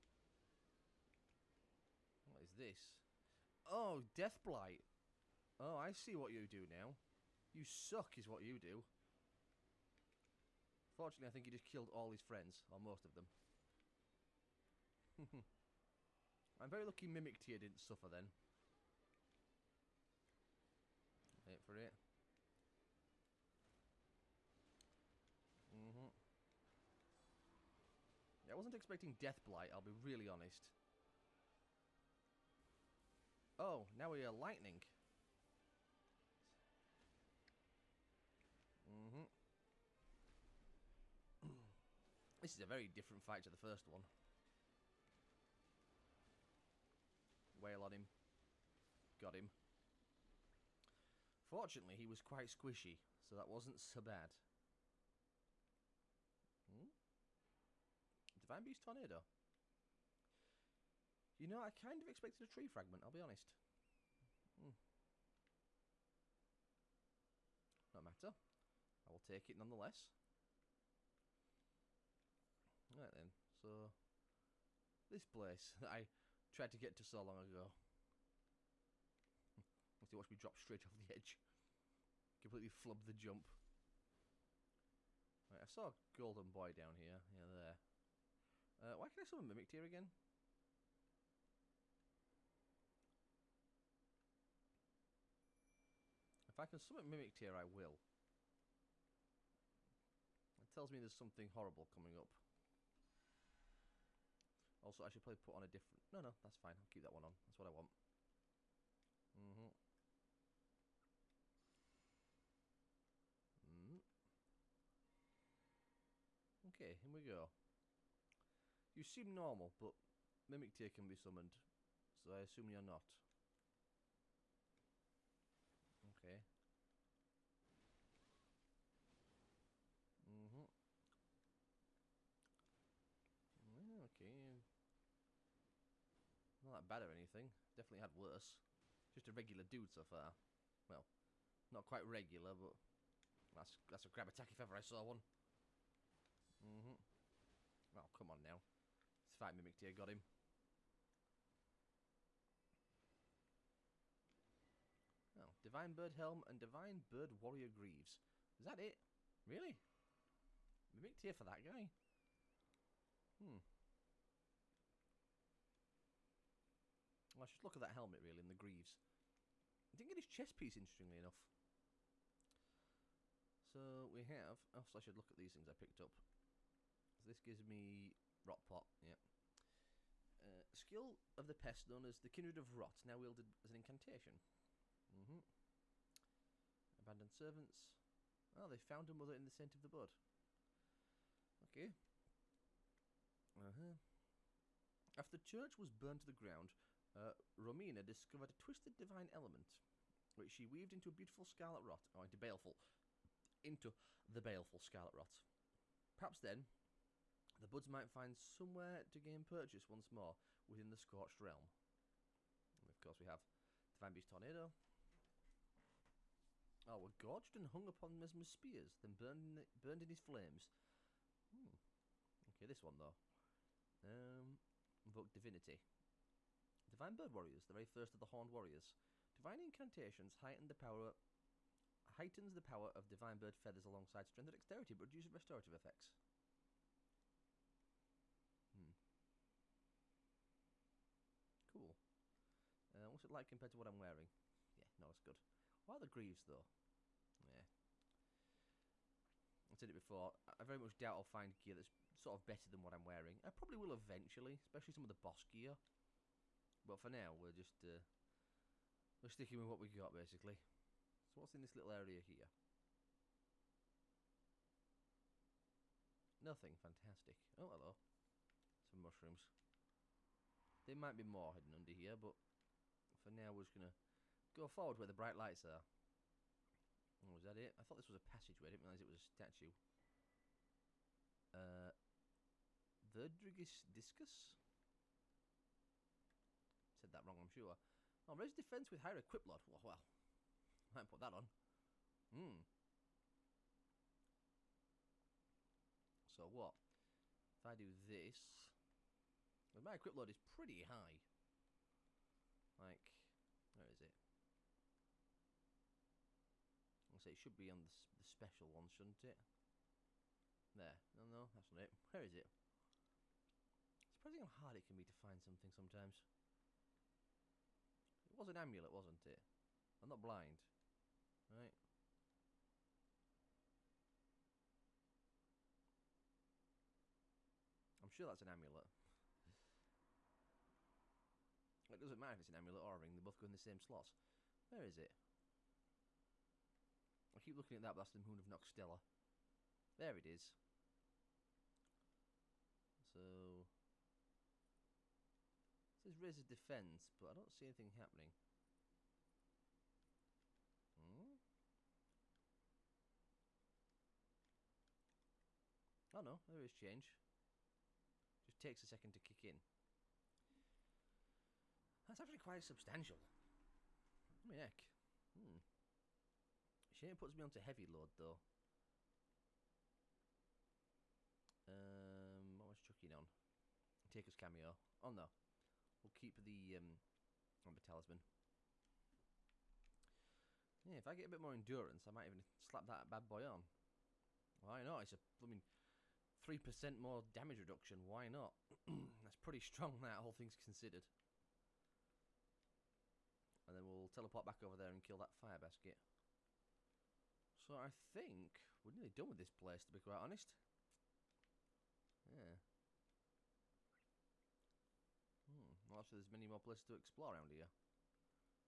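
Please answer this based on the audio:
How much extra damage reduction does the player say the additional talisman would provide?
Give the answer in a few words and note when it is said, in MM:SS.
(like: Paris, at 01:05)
3%, at 06:26.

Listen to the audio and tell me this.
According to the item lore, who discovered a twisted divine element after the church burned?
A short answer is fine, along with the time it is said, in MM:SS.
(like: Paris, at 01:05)
Romina, at 03:17.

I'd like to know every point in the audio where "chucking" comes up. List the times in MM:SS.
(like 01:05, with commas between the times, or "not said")
06:12.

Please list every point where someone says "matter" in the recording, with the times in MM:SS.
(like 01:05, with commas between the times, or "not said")
01:08, 05:32.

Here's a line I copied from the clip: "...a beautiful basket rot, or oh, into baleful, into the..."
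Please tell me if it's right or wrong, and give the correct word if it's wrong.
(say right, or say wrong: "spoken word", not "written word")
wrong: "scarlet", not "basket".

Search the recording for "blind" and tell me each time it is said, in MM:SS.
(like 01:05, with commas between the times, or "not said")
05:20.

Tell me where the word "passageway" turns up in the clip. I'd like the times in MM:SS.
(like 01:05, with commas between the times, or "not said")
04:38.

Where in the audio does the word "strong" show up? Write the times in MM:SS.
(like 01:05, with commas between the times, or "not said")
06:29.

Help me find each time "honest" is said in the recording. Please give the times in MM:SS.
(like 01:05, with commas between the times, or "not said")
00:30, 01:03, 06:40.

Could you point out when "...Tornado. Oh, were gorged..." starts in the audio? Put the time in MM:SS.
03:34.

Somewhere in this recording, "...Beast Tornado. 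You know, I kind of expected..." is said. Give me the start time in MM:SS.
00:58.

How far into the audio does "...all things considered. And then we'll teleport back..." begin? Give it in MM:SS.
06:30.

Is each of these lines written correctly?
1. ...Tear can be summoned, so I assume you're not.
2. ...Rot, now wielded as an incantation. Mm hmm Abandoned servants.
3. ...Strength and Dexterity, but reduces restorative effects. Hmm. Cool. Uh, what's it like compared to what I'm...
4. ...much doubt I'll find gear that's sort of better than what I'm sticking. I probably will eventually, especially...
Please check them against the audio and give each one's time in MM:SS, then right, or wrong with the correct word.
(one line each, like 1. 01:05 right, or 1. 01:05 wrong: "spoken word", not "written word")
1. 02:00 right
2. 03:02 right
3. 03:54 right
4. 04:10 wrong: "wearing", not "sticking".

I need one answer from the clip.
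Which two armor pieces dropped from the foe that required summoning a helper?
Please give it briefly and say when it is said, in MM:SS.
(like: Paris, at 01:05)
Divine Bird Helm and Divine Bird Warrior Greaves, at 02:35.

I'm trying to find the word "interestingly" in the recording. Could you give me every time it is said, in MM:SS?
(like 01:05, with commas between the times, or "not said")
02:50.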